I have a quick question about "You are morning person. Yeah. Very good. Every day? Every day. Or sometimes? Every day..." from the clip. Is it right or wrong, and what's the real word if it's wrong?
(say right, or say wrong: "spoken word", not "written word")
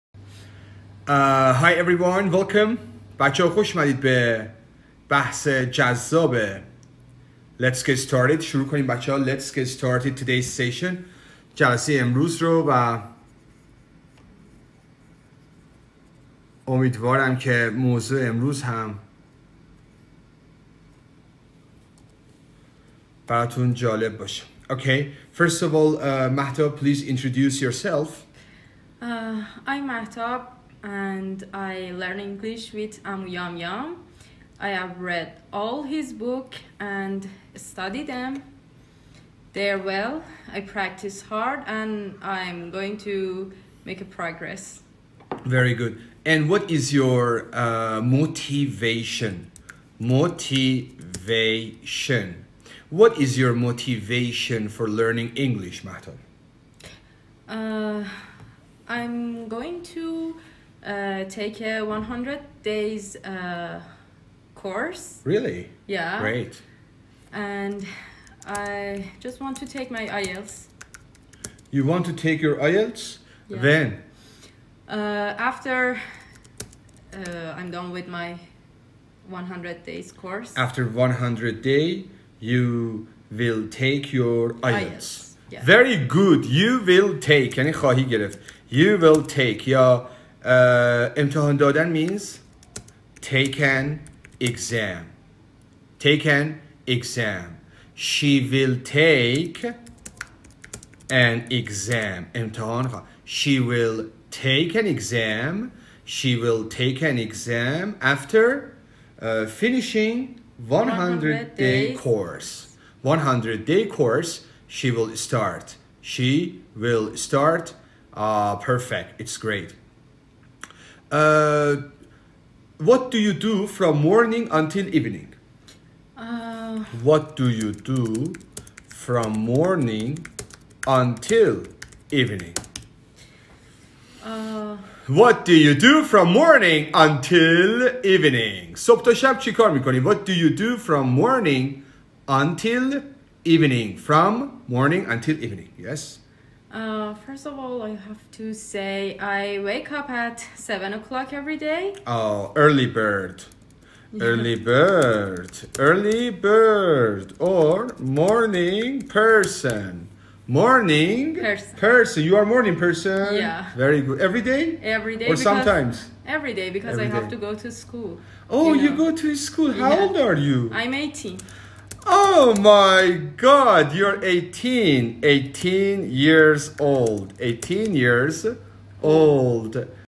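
right.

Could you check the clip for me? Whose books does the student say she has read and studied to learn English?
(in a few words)
Amu Yum Yum.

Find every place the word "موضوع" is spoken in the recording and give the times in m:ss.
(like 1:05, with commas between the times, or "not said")
0:17.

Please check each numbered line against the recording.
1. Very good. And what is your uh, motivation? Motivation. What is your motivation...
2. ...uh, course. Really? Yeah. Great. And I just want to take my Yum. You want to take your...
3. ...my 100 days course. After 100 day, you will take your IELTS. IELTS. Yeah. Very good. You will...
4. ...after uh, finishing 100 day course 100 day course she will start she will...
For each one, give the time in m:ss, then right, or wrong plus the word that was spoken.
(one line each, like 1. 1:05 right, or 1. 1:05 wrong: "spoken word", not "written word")
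1. 0:45 right
2. 1:03 wrong: "IELTS", not "Yum"
3. 1:18 right
4. 1:48 right.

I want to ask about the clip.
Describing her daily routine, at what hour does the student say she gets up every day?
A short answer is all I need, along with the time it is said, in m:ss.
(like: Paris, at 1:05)
7 o'clock, at 2:30.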